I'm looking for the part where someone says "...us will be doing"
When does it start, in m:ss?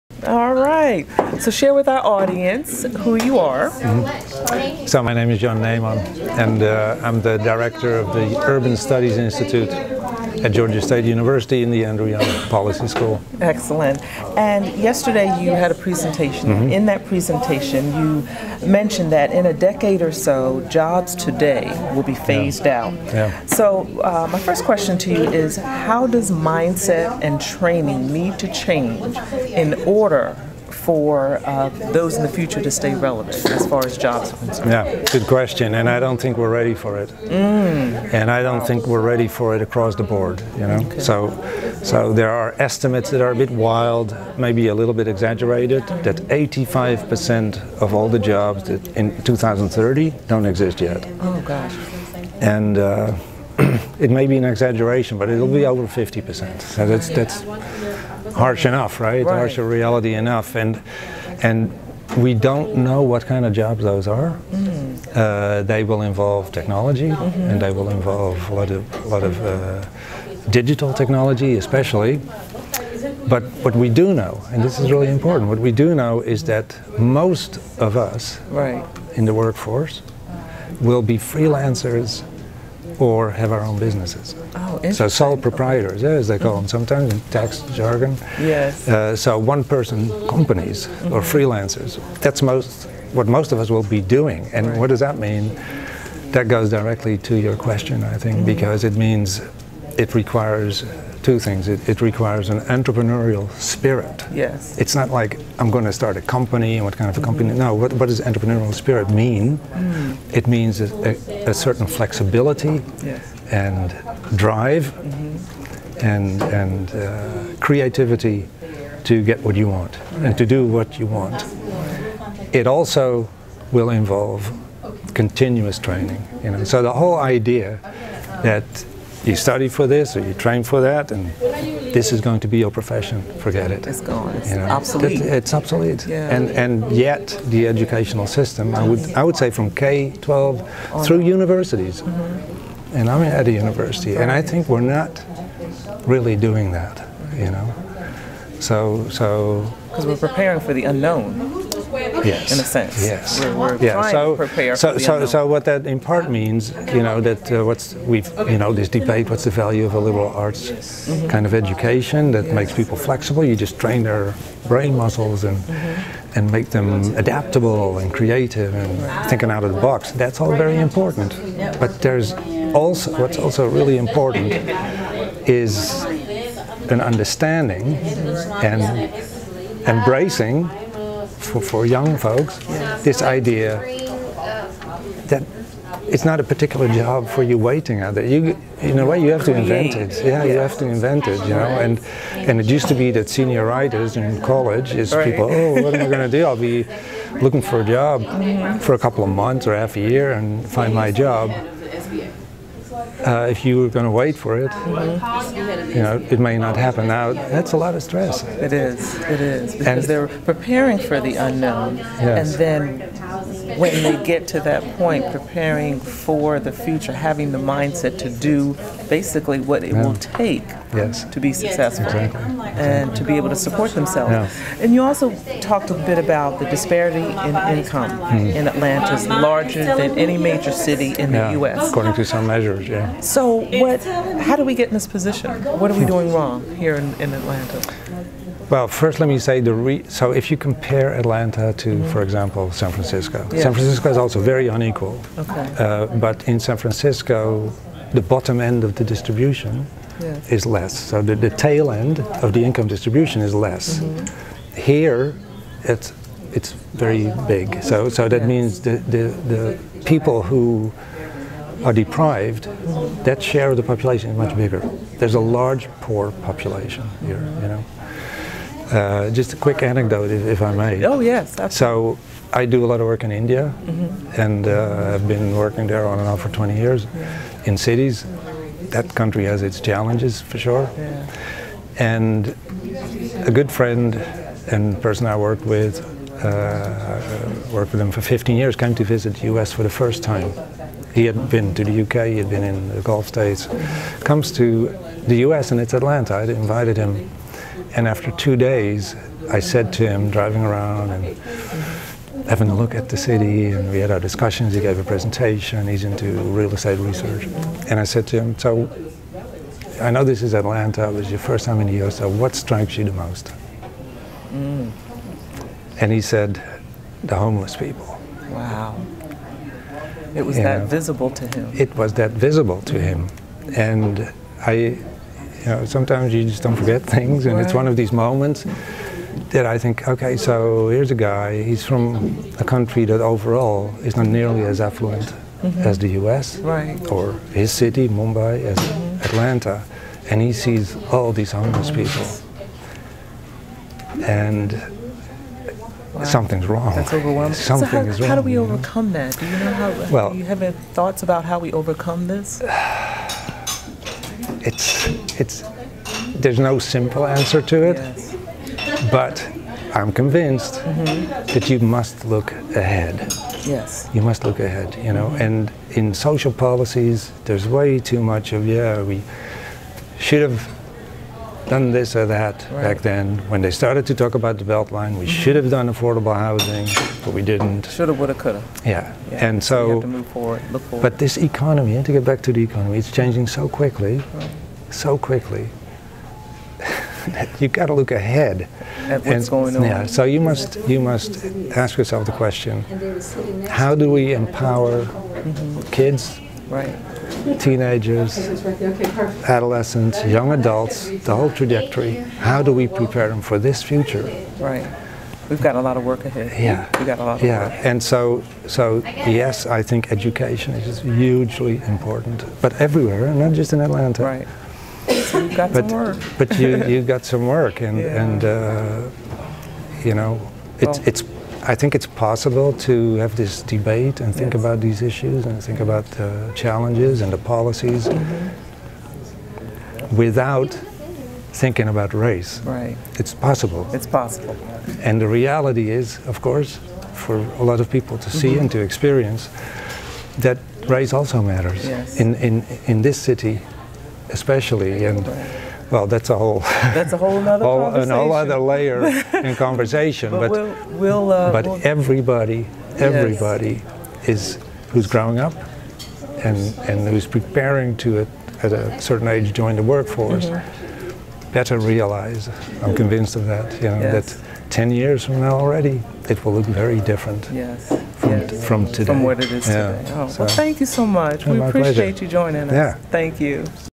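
1:33.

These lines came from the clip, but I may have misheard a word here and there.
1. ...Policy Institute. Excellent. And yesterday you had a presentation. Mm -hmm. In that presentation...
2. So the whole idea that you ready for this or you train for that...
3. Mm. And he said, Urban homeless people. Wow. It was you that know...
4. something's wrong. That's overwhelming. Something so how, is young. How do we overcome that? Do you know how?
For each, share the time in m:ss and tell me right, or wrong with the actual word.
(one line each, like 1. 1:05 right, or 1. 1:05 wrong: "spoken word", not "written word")
1. 0:12 wrong: "School", not "Institute"
2. 2:06 wrong: "study", not "ready"
3. 5:14 wrong: "The", not "Urban"
4. 5:46 wrong: "wrong", not "young".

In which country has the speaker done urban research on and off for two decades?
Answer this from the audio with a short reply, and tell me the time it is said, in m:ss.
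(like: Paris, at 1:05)
India, at 4:33.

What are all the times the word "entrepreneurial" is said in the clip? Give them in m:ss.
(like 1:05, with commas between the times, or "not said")
1:42, 1:48.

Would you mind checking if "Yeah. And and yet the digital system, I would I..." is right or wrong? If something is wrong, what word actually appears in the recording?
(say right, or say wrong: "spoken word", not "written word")
wrong: "educational", not "digital".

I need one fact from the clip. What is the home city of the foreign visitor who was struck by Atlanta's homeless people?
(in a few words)
Mumbai.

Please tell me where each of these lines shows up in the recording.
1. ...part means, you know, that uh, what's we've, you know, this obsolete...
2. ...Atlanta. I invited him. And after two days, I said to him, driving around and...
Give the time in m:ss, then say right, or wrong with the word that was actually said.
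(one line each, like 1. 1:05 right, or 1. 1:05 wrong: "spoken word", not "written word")
1. 2:35 wrong: "debate", not "obsolete"
2. 4:55 right.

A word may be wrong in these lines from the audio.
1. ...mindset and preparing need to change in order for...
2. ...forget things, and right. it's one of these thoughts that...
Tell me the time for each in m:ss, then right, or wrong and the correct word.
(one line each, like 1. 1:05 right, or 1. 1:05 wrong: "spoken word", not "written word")
1. 0:26 wrong: "training", not "preparing"
2. 5:26 wrong: "moments", not "thoughts".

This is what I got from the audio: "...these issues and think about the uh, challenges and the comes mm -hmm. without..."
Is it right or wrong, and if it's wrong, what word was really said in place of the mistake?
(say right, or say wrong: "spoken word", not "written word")
wrong: "policies", not "comes".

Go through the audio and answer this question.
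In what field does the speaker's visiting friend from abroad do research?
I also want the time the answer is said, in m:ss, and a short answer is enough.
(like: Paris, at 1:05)
Real estate research, at 5:06.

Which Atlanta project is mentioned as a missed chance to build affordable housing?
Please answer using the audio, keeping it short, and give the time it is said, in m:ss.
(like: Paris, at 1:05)
The Beltline, at 6:14.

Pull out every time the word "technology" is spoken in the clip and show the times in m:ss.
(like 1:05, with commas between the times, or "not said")
1:06, 1:10.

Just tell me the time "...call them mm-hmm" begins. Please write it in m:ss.
1:26.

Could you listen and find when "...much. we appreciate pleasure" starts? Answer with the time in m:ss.
7:51.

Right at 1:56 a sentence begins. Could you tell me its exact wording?
and, and uh, creativity to get what you want right.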